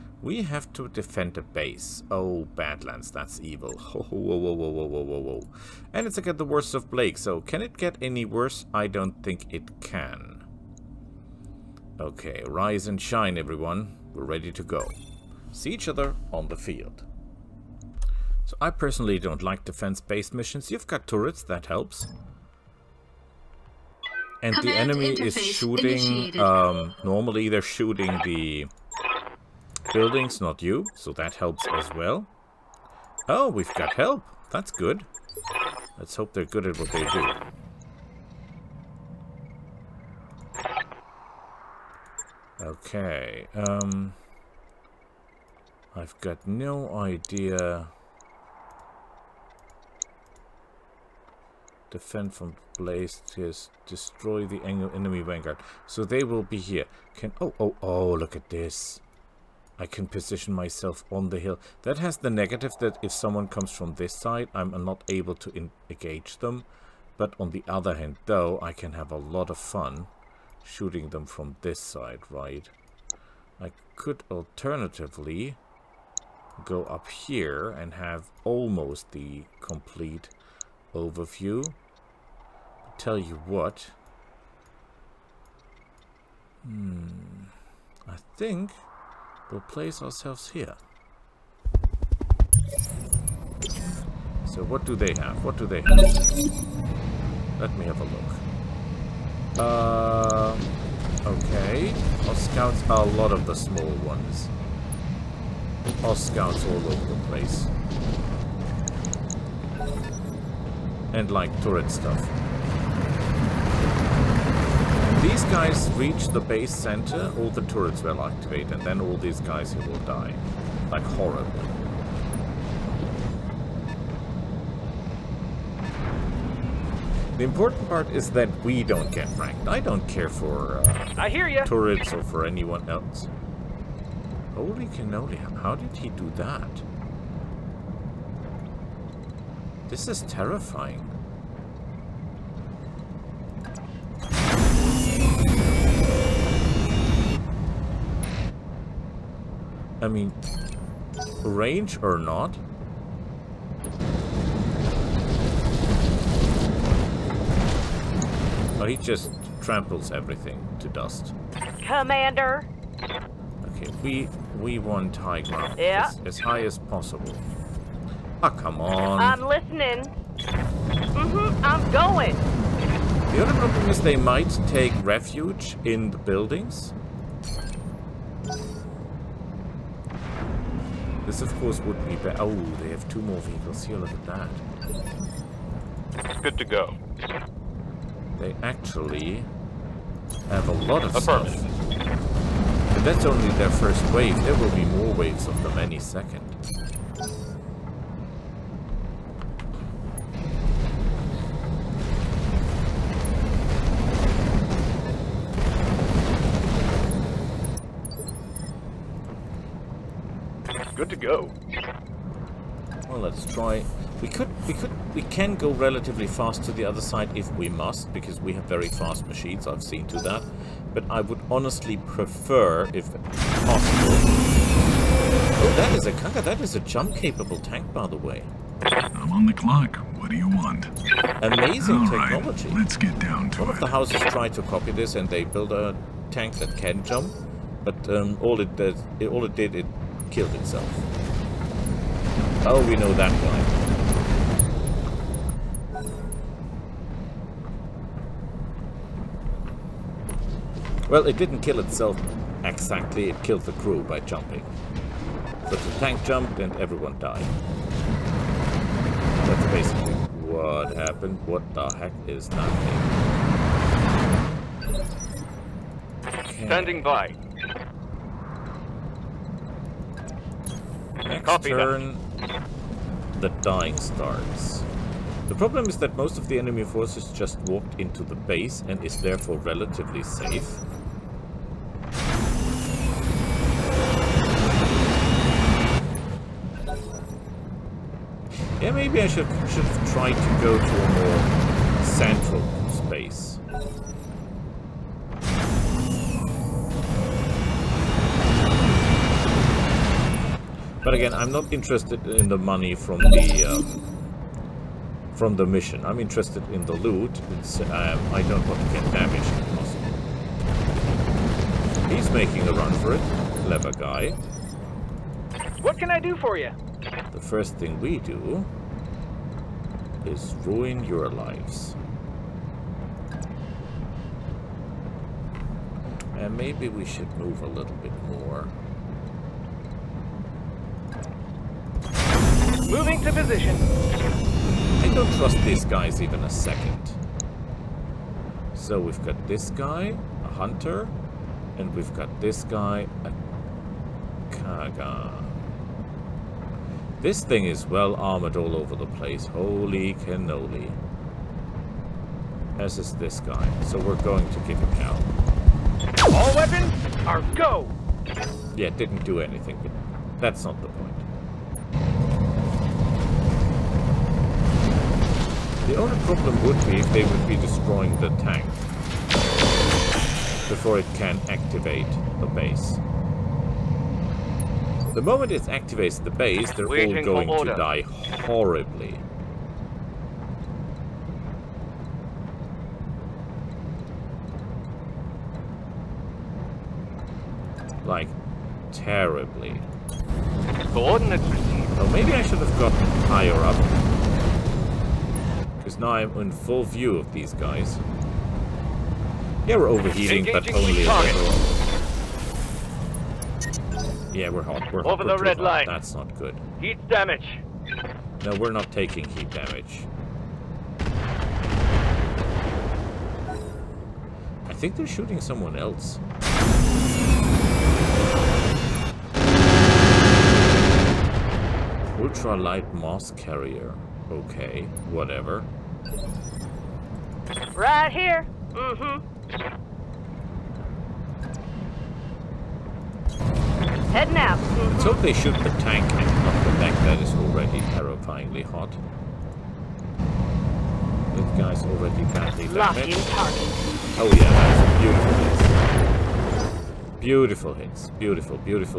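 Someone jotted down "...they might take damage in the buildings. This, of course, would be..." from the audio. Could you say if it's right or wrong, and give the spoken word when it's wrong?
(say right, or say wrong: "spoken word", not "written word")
wrong: "refuge", not "damage".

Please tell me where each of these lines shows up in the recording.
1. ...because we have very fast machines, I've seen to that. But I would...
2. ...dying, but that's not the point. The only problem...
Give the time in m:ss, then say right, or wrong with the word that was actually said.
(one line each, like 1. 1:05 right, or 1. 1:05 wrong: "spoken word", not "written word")
1. 3:38 right
2. 5:59 wrong: "anything", not "dying".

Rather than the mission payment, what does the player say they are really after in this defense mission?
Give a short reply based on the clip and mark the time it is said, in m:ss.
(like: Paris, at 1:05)
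the loot, at 5:06.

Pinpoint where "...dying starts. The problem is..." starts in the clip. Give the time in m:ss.
4:33.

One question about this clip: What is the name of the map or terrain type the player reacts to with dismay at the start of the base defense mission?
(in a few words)
Badlands.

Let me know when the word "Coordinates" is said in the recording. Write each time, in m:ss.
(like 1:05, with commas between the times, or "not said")
6:30.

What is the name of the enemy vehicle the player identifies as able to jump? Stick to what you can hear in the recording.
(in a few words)
Kanga.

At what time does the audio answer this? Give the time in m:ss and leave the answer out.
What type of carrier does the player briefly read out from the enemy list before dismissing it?
7:02.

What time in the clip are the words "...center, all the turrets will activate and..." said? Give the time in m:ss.
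1:56.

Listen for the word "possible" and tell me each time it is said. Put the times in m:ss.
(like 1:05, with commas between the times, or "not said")
2:46, 3:43, 5:09.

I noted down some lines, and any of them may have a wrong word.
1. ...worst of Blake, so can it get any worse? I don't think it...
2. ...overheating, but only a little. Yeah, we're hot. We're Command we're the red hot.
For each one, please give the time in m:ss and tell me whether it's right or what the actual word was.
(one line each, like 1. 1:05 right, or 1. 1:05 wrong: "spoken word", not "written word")
1. 0:06 right
2. 6:39 wrong: "Over", not "Command".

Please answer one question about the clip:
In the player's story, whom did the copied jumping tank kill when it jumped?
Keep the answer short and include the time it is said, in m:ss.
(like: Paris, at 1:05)
the crew, at 4:13.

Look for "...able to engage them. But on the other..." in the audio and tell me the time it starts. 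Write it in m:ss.
1:05.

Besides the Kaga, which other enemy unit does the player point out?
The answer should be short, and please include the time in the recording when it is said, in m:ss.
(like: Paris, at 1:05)
a hunter, at 5:40.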